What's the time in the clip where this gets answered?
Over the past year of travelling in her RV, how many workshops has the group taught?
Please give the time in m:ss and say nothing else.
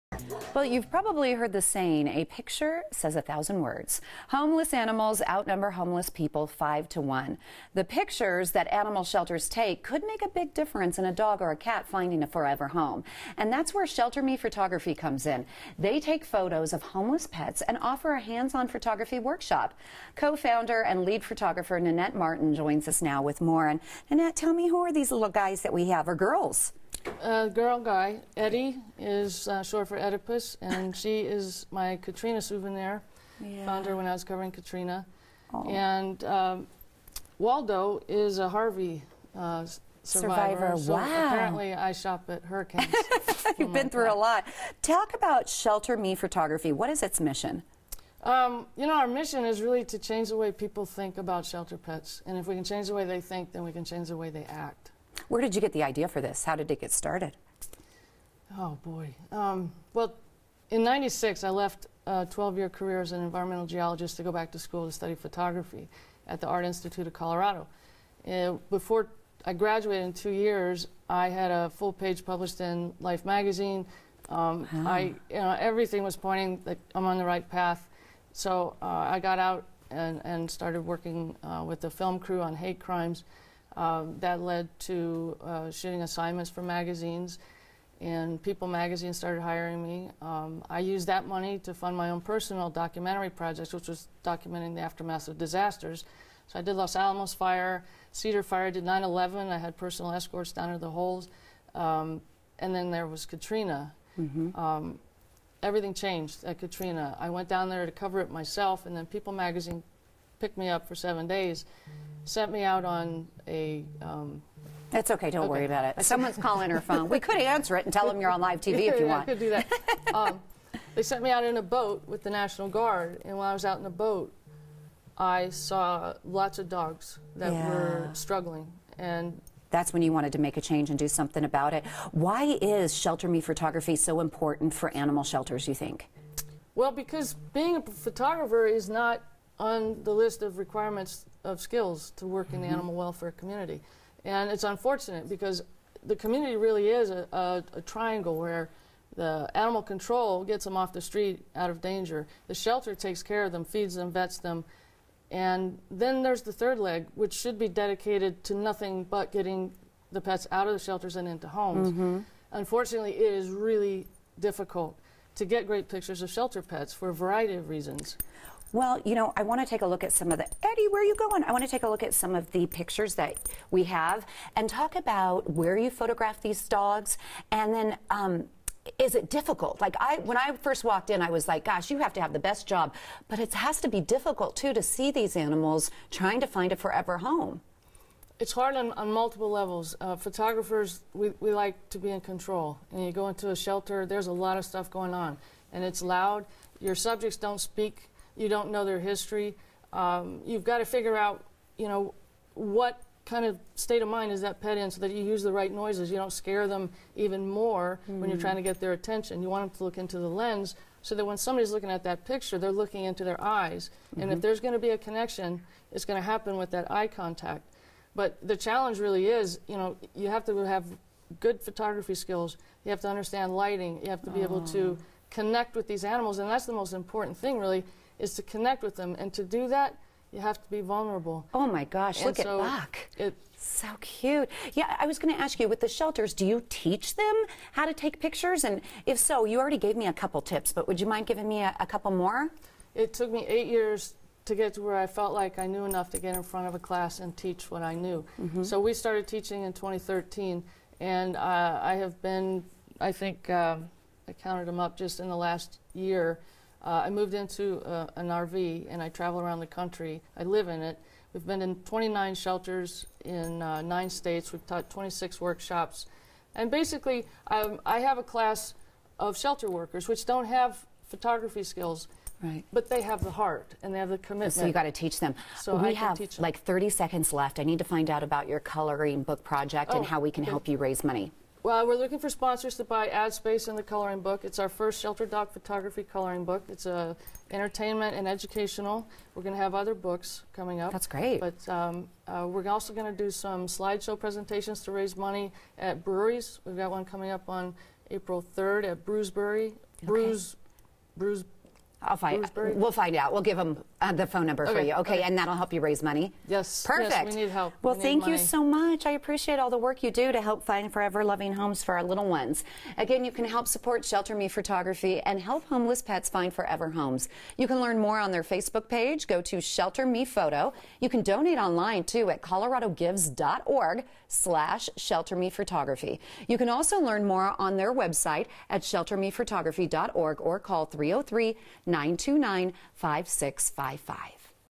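4:24.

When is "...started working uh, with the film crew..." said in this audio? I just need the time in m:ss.
1:20.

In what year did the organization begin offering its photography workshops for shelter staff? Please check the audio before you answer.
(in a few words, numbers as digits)
2013.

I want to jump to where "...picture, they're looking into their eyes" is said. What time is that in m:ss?
3:32.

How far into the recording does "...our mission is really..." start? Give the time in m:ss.
0:48.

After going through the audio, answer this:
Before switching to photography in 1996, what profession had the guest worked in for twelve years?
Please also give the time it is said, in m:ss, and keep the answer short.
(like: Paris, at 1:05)
Environmental geologist, at 1:03.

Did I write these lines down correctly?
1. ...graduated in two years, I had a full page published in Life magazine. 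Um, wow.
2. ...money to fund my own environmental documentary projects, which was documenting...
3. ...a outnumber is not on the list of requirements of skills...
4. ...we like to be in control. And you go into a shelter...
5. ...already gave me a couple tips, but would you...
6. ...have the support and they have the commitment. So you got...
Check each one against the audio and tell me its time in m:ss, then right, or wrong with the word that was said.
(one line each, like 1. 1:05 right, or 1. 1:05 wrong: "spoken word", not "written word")
1. 1:09 right
2. 1:31 wrong: "personal", not "environmental"
3. 2:17 wrong: "photographer", not "outnumber"
4. 3:11 right
5. 3:59 right
6. 4:33 wrong: "heart", not "support".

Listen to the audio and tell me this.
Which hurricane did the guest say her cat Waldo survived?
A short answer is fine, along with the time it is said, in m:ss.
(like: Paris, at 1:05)
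Harvey, at 0:38.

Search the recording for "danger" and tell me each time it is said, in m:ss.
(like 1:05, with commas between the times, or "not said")
2:31.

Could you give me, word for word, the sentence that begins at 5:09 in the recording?
I appreciate all the work you do to help find forever loving homes for our little ones.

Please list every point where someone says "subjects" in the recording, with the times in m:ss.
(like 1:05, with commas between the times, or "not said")
3:16.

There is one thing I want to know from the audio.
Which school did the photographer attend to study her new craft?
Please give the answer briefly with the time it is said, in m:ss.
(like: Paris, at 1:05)
Art Institute of Colorado, at 1:06.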